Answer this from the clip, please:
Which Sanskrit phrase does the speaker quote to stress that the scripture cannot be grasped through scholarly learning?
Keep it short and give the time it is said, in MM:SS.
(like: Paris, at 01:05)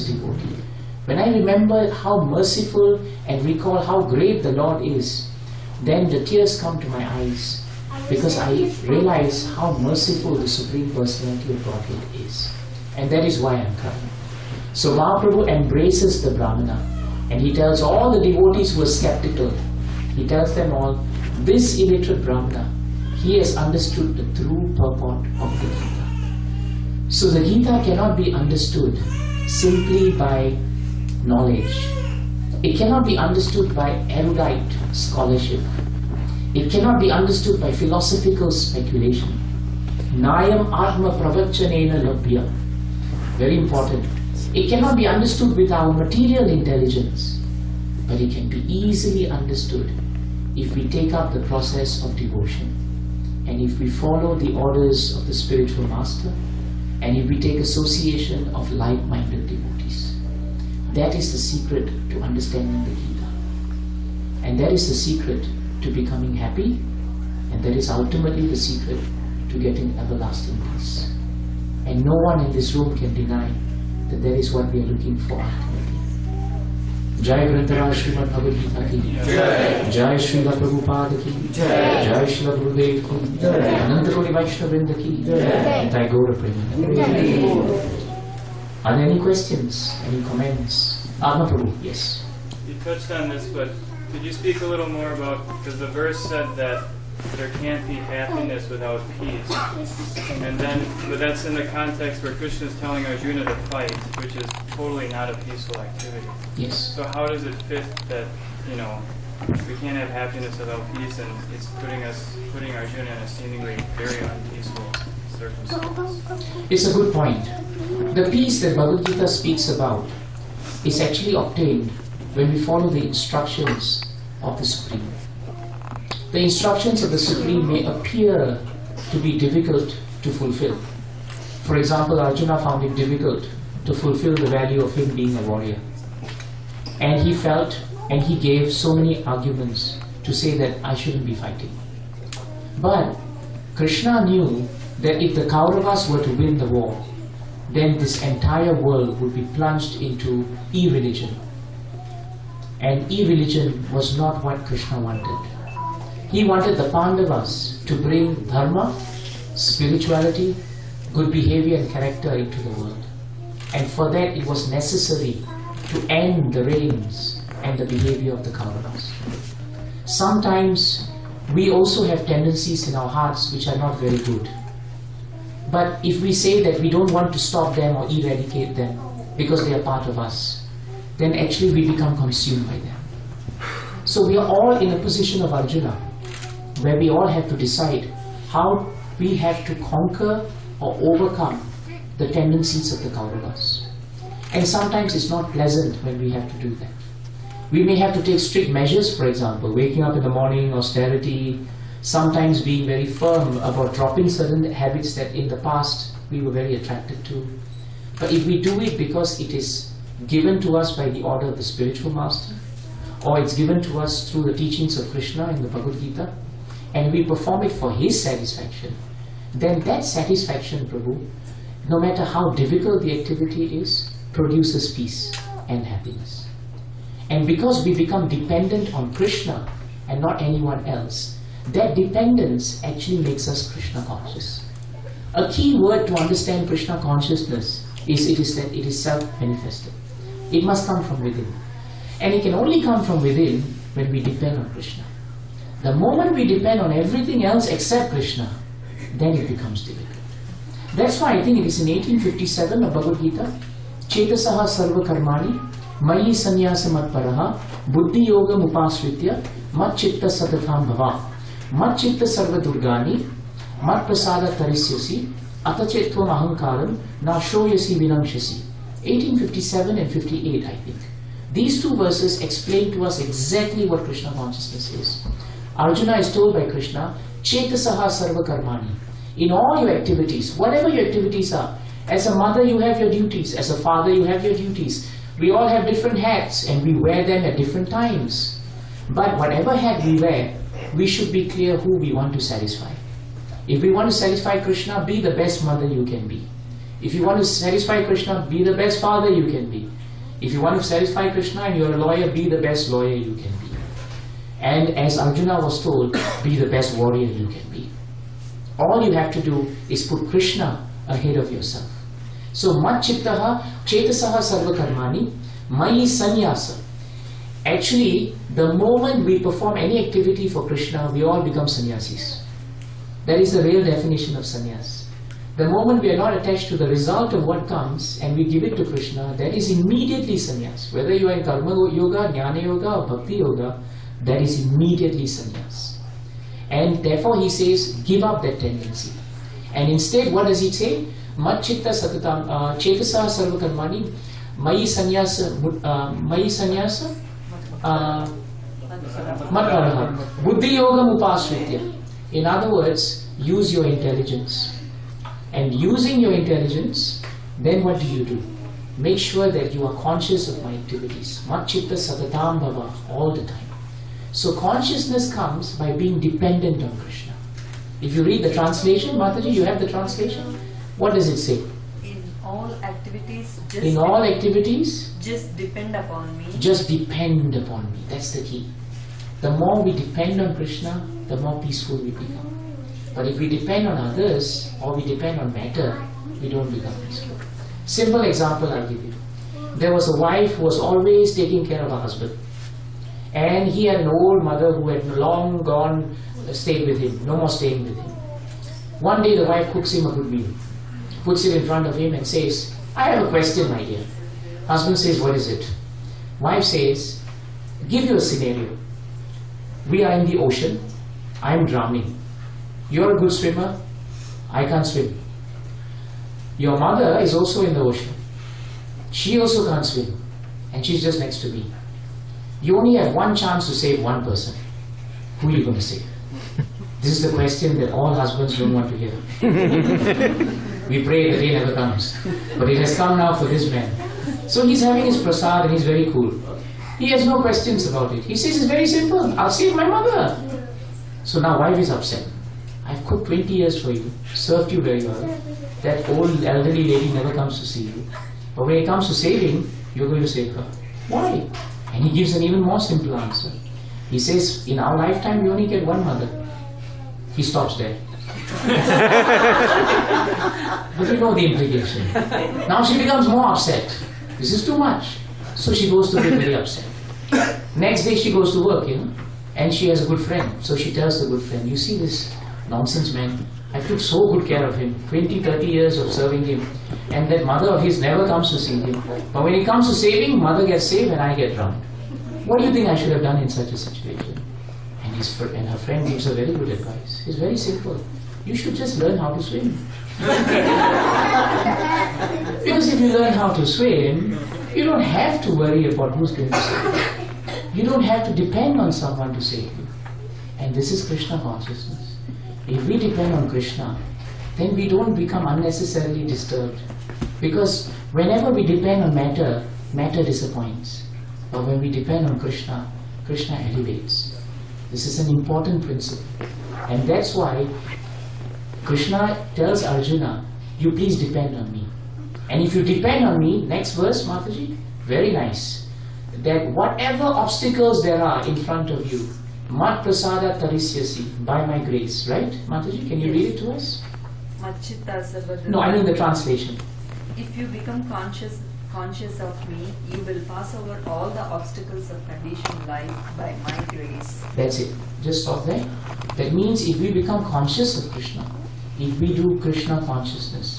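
Nayam Atma Pravachanena Labhya, at 00:40.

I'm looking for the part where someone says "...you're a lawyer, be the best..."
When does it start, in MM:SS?
05:01.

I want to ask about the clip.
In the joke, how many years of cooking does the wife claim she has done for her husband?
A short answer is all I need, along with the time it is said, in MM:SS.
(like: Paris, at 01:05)
20, at 07:23.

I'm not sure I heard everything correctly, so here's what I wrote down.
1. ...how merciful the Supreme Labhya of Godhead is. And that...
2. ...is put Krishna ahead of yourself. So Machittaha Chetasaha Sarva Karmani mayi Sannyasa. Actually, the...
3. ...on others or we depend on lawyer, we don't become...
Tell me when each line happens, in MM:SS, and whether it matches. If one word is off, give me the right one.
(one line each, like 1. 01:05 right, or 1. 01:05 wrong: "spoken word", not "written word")
1. 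00:09 wrong: "Personality", not "Labhya"
2. 05:09 right
3. 06:23 wrong: "matter", not "lawyer".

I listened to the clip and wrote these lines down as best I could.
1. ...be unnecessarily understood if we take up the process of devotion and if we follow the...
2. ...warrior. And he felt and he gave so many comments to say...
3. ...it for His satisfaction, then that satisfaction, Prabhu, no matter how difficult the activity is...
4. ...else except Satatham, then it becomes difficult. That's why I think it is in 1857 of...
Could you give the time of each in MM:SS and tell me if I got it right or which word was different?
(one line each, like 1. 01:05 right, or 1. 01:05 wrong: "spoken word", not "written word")
1. 00:48 wrong: "easily", not "unnecessarily"
2. 02:15 wrong: "arguments", not "comments"
3. 03:37 right
4. 04:07 wrong: "Krishna", not "Satatham".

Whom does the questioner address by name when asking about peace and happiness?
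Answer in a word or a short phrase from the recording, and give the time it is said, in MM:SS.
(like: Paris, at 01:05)
Adma Prabhu, at 01:31.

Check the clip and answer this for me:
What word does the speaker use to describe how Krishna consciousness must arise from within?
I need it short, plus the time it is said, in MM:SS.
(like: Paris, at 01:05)
self-manifested, at 03:59.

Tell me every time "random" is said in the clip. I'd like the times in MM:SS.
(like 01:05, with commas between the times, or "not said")
not said.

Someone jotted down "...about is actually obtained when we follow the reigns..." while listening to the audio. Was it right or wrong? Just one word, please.
wrong.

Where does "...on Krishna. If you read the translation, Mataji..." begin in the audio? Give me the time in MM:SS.
06:06.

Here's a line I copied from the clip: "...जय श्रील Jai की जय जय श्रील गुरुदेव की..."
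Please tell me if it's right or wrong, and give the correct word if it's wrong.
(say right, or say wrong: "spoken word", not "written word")
right.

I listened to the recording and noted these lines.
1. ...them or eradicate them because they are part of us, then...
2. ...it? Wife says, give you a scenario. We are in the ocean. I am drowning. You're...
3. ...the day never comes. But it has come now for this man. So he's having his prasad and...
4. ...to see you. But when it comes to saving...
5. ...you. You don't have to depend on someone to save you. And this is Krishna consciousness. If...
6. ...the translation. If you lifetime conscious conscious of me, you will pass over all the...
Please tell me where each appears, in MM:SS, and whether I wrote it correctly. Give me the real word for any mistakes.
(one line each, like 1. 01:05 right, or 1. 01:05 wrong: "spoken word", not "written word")
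1. 02:57 right
2. 06:45 right
3. 07:11 right
4. 07:27 right
5. 08:16 right
6. 08:56 wrong: "become", not "lifetime".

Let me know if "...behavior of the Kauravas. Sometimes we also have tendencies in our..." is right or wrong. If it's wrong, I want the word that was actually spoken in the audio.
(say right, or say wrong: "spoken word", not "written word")
right.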